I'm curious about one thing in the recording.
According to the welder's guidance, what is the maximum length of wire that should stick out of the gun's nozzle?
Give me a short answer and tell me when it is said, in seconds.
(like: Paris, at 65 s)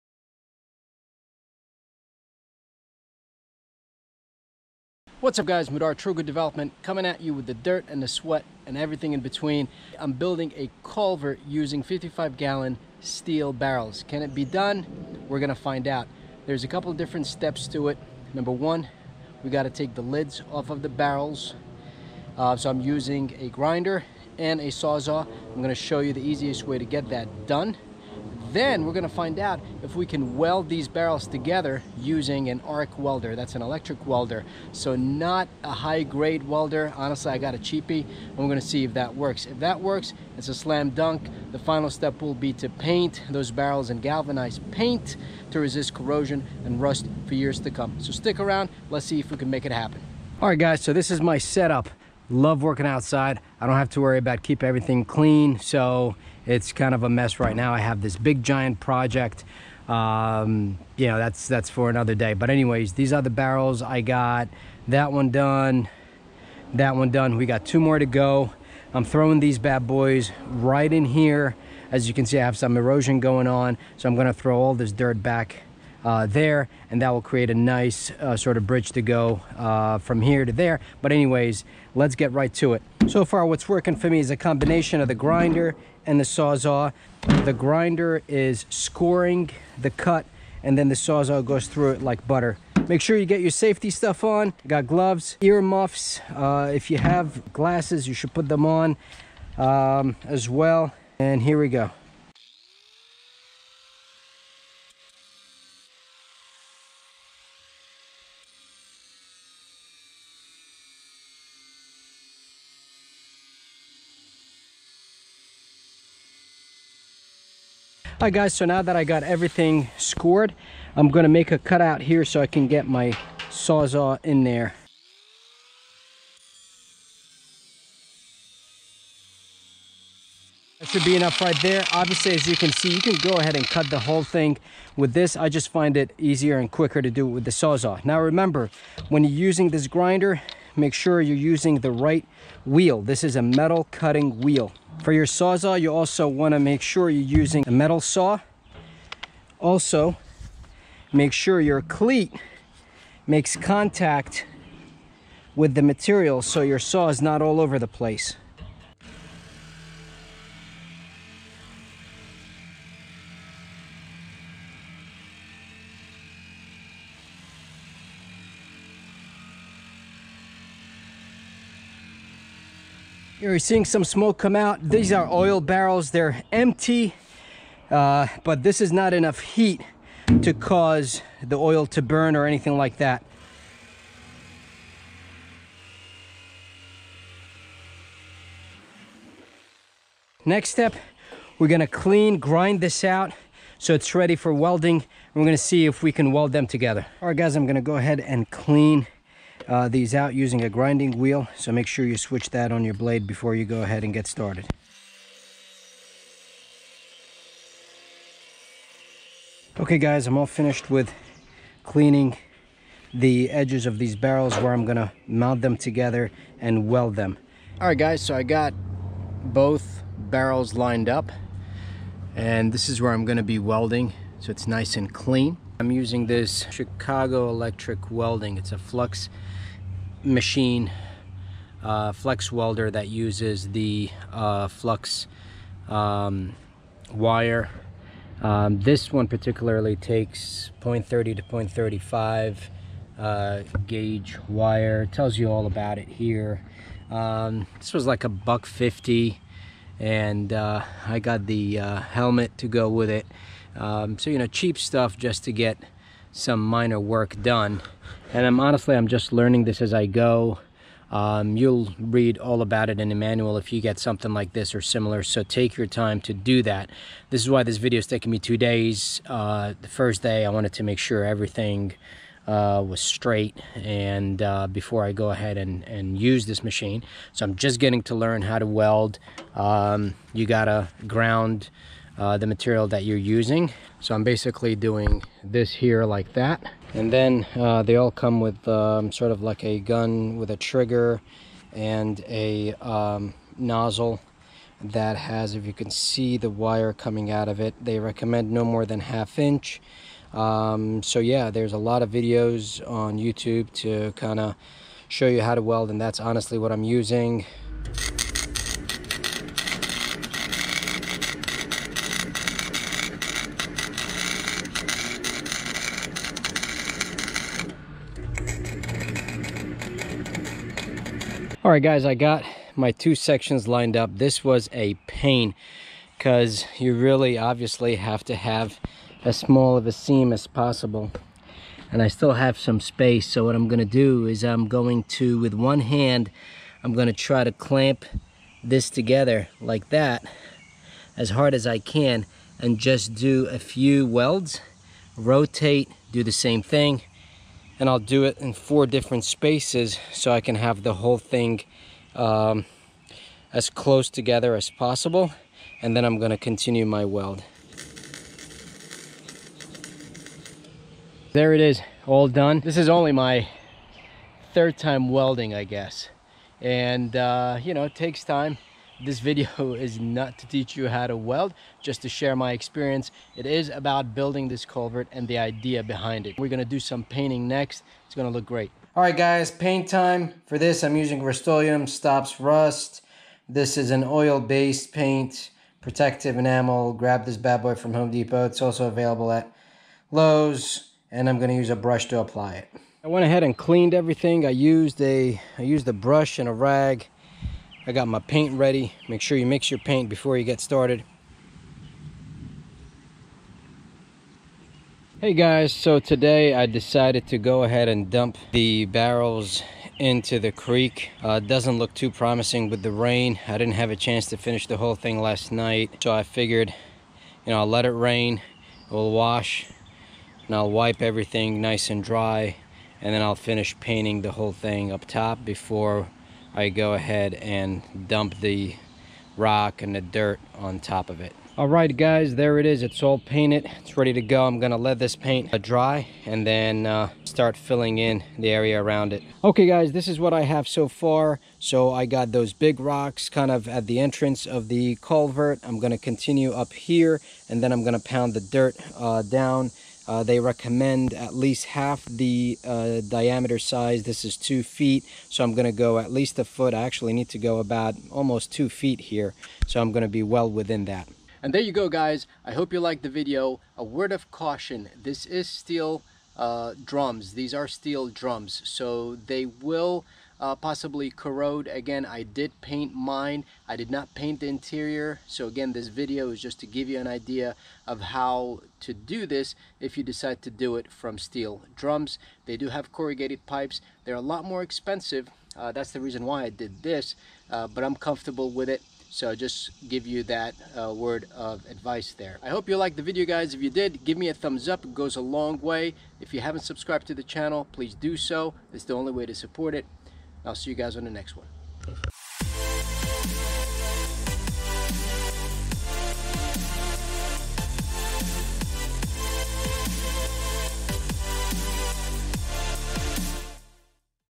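half inch, at 298 s.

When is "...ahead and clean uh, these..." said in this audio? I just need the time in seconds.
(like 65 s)
197 s.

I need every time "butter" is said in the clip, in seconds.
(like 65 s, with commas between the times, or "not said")
92 s.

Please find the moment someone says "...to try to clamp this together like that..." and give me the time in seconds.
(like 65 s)
337 s.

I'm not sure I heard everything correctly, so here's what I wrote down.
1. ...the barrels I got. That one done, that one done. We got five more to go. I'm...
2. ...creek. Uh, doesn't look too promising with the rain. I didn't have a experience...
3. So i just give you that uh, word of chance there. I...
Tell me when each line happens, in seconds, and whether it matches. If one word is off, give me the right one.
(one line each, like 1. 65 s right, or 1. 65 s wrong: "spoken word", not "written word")
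1. 63 s wrong: "two", not "five"
2. 410 s wrong: "chance", not "experience"
3. 489 s wrong: "advice", not "chance".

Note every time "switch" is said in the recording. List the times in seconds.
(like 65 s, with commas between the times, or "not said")
202 s.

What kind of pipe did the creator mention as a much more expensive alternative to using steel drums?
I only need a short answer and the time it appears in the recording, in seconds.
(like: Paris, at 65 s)
corrugated pipes, at 482 s.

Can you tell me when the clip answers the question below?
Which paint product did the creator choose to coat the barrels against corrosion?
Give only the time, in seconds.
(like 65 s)
381 s.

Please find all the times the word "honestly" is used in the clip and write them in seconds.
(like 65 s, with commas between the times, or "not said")
36 s, 258 s, 306 s.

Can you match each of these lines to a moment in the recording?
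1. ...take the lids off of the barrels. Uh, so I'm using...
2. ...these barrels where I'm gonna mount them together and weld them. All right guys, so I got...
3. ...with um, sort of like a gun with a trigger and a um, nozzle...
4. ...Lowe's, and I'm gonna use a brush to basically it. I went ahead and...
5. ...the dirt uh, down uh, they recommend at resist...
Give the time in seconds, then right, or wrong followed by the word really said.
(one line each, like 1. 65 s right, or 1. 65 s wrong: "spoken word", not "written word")
1. 19 s right
2. 213 s right
3. 288 s right
4. 390 s wrong: "apply", not "basically"
5. 448 s wrong: "least", not "resist".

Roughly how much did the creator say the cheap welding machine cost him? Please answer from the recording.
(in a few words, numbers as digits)
a buck 50.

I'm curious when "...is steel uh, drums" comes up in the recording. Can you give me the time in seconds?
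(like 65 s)
465 s.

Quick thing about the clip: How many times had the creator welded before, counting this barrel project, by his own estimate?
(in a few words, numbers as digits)
3rd time.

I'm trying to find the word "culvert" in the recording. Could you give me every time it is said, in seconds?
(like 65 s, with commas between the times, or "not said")
10 s, 374 s, 445 s.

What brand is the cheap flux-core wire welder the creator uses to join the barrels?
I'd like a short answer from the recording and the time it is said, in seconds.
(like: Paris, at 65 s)
Chicago Electric, at 226 s.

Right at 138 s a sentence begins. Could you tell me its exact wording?
Now remember, when you're using this grinder, make sure you're using the right wheel.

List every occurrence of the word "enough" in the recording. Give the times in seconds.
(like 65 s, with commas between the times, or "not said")
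131 s, 179 s.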